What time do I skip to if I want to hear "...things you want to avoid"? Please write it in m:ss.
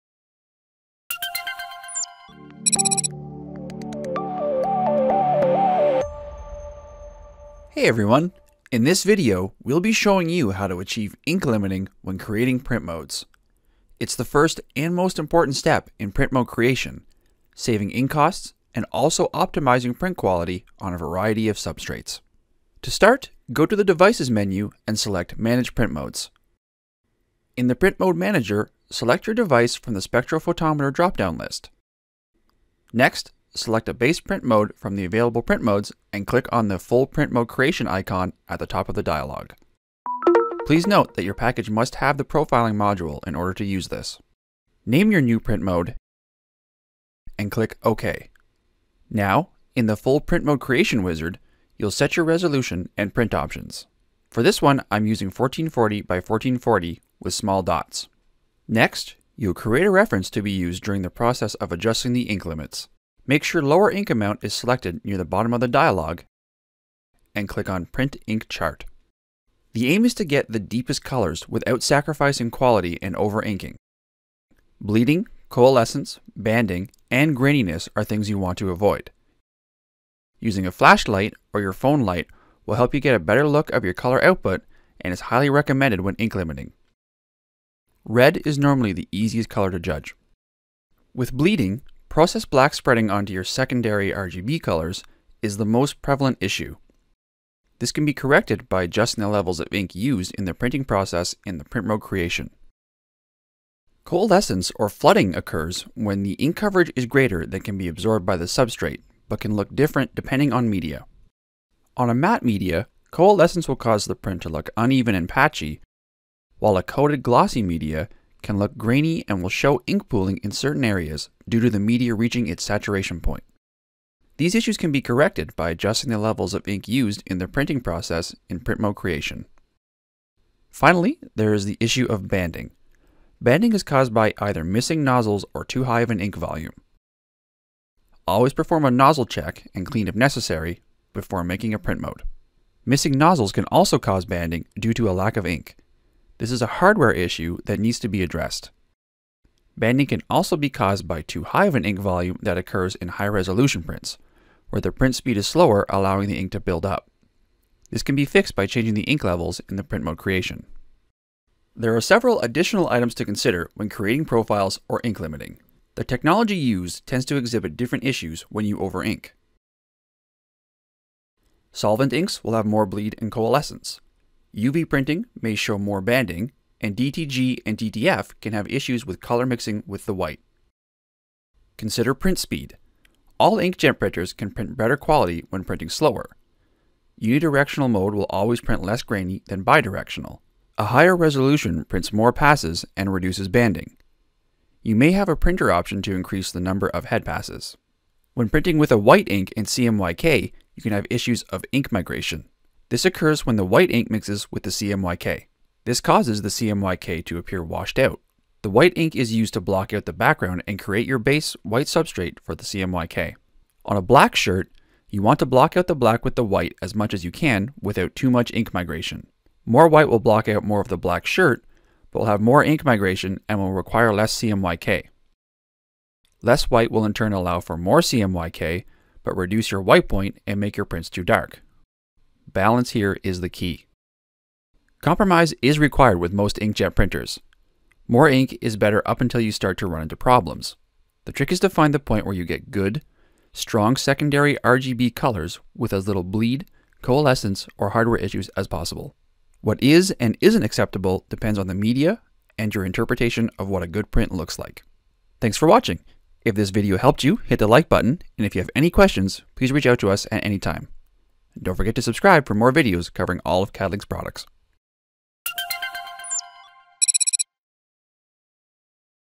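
1:18.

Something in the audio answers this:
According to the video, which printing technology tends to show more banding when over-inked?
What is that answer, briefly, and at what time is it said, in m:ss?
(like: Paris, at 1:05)
UV printing, at 2:54.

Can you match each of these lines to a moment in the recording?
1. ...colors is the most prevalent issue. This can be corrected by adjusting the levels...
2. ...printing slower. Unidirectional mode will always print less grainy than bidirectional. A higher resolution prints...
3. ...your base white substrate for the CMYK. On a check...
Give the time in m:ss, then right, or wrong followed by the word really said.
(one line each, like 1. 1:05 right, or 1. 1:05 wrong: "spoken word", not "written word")
1. 1:34 right
2. 3:05 right
3. 3:31 wrong: "black", not "check".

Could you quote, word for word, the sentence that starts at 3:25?
This causes the CMYK to appear washed out.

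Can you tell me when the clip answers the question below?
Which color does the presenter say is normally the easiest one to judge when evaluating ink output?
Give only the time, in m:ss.
1:28.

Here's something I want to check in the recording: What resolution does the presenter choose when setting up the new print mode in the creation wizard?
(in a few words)
1440 by 1440.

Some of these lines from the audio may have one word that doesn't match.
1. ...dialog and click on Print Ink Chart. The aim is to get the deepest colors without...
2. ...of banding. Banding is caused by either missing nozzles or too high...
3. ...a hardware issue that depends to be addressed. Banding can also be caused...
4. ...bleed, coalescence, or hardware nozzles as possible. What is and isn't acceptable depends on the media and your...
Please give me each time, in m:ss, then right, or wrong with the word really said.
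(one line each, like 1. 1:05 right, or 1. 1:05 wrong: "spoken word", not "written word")
1. 1:05 right
2. 2:12 right
3. 2:26 wrong: "needs", not "depends"
4. 4:06 wrong: "issues", not "nozzles".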